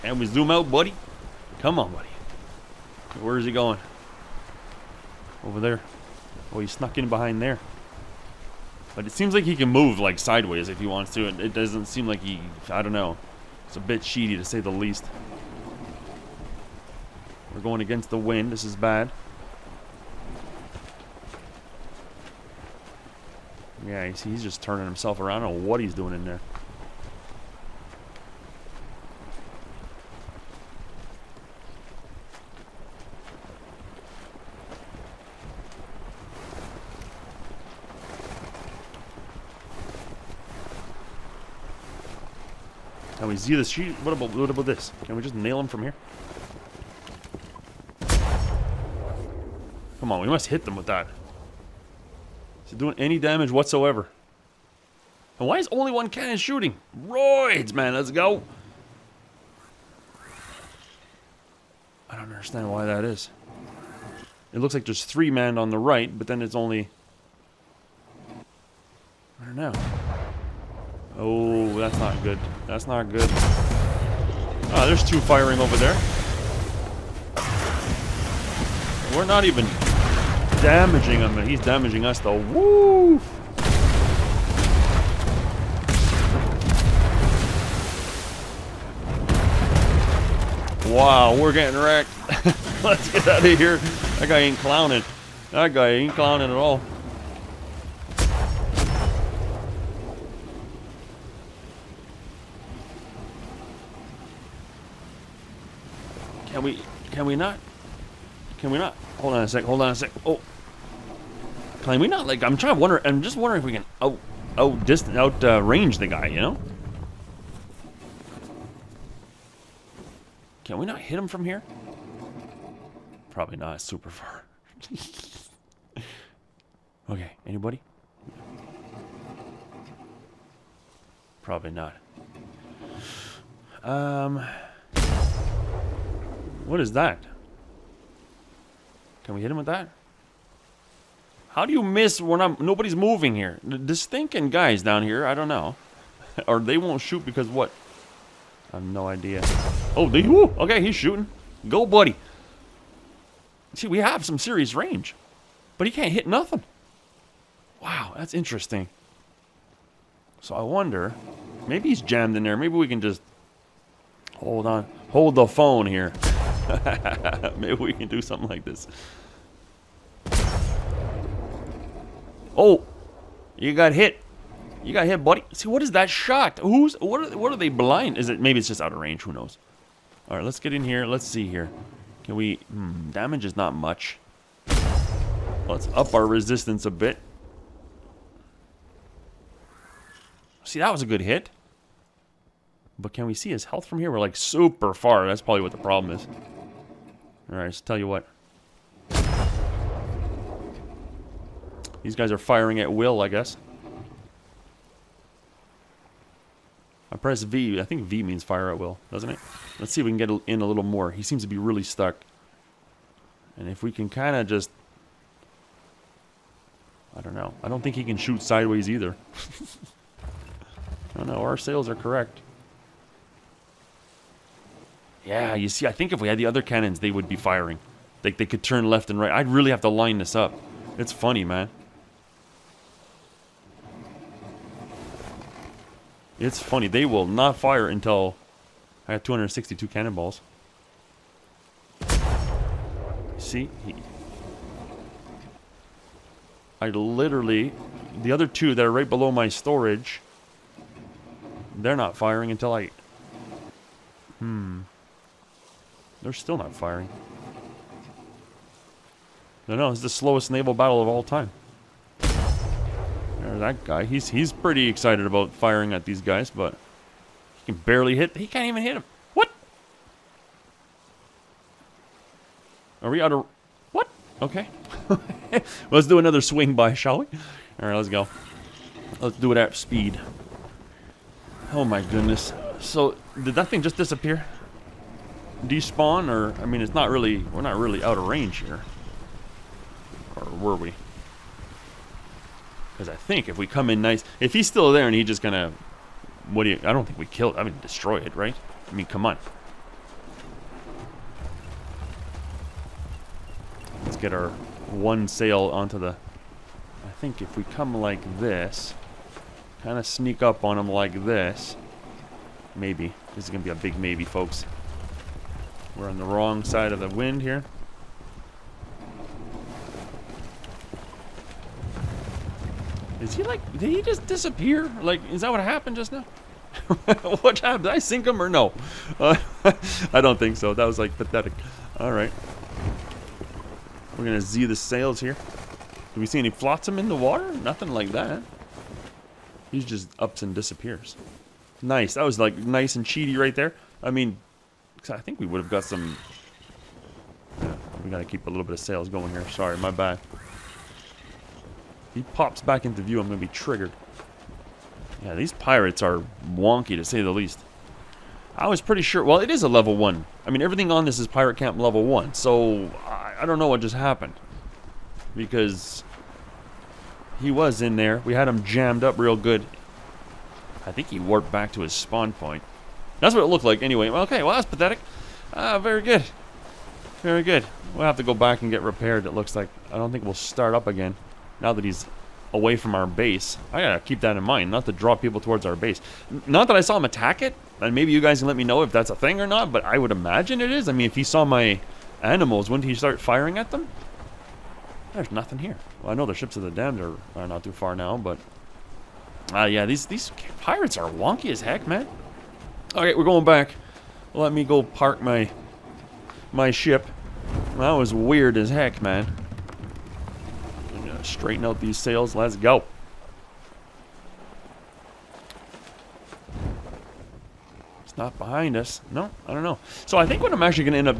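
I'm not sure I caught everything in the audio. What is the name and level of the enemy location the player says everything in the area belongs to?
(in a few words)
Pirate Camp level 1.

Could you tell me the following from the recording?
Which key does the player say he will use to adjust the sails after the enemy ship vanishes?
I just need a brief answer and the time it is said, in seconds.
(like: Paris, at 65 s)
Z, at 334 s.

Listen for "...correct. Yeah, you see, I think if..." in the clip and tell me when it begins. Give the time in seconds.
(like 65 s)
221 s.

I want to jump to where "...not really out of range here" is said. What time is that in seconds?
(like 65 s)
287 s.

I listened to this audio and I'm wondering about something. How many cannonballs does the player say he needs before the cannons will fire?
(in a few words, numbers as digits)
262.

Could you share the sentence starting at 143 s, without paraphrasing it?
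The stinking guys down here, I don't know.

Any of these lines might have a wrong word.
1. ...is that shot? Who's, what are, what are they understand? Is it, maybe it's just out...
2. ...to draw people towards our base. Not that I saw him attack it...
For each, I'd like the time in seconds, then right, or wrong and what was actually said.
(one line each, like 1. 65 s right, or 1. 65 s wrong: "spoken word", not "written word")
1. 175 s wrong: "blind", not "understand"
2. 384 s right.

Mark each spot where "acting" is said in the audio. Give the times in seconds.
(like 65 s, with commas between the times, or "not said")
not said.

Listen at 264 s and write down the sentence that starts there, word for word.
He's he's pretty excited about firing at these guys, but he can barely hit.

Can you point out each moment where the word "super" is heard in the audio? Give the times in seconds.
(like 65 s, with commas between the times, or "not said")
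123 s, 194 s.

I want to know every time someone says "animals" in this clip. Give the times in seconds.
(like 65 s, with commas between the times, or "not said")
392 s.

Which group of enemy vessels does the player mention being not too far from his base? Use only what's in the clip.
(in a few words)
ships of the damned.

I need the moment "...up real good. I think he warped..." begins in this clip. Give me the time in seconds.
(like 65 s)
369 s.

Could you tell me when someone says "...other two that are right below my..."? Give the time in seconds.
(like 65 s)
248 s.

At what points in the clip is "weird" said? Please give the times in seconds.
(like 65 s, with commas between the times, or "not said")
408 s.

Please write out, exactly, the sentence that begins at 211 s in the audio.
He seems to be really stuck.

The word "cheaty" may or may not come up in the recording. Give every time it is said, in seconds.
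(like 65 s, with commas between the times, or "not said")
14 s, 343 s.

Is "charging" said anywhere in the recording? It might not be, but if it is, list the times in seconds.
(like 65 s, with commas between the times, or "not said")
not said.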